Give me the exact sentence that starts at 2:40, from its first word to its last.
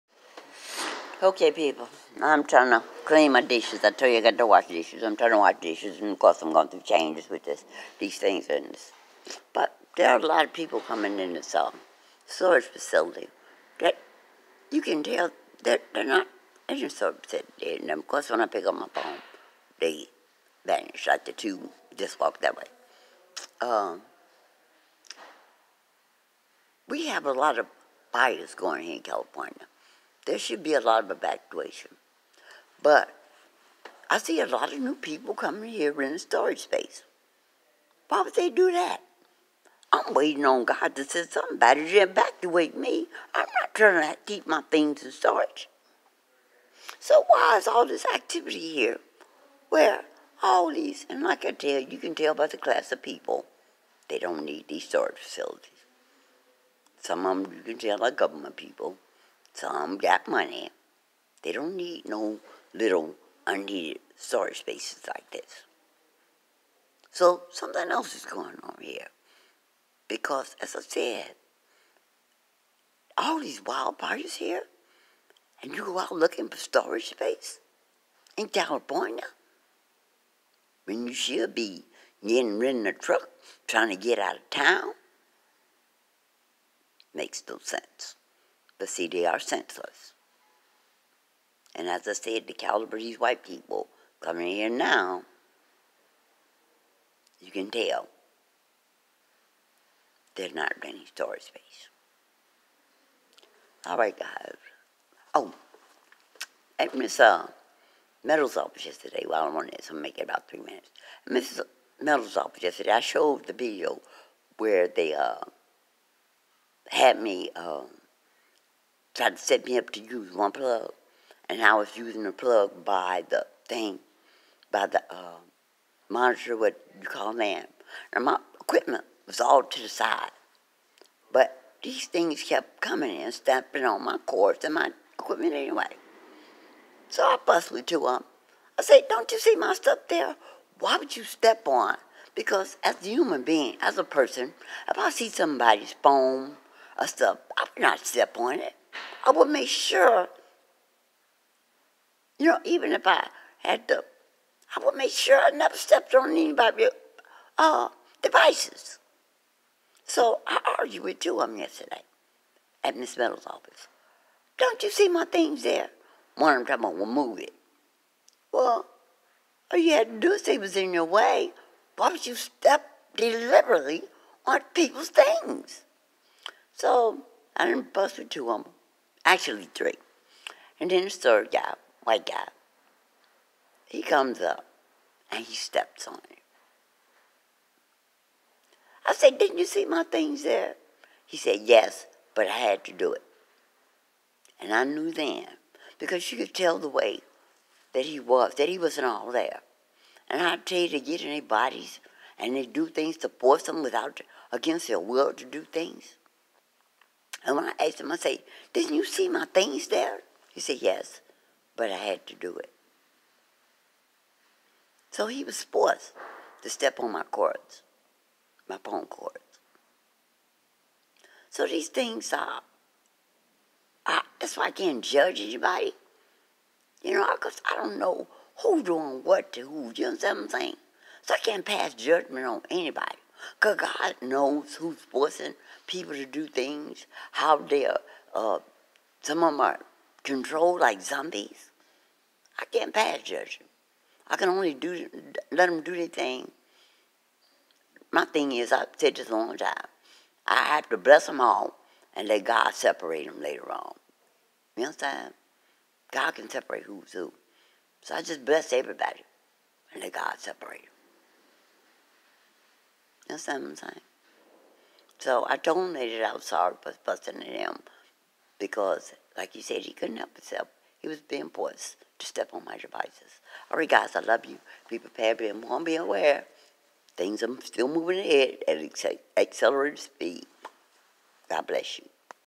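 So I argued with two of them yesterday at Miss Meadows' office.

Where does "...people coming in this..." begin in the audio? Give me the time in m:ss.
0:10.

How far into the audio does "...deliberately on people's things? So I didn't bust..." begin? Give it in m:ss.
2:53.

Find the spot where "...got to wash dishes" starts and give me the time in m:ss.
0:04.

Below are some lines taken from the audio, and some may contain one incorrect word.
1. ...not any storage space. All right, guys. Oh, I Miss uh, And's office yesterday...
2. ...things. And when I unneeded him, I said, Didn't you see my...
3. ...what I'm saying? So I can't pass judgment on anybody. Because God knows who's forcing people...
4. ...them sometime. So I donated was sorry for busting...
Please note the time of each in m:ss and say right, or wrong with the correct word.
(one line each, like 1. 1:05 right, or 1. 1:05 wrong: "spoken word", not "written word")
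1. 1:40 wrong: "Metal", not "And"
2. 3:25 wrong: "asked", not "unneeded"
3. 3:50 right
4. 4:20 right.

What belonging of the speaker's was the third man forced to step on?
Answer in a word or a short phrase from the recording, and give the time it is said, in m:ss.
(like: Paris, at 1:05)
phone cords, at 3:38.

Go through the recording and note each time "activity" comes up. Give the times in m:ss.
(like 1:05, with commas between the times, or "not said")
0:48.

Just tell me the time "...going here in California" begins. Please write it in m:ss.
0:28.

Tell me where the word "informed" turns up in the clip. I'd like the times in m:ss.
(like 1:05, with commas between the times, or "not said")
4:35.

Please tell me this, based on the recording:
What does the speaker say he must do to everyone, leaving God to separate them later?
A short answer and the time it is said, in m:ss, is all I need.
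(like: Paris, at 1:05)
bless them, at 4:10.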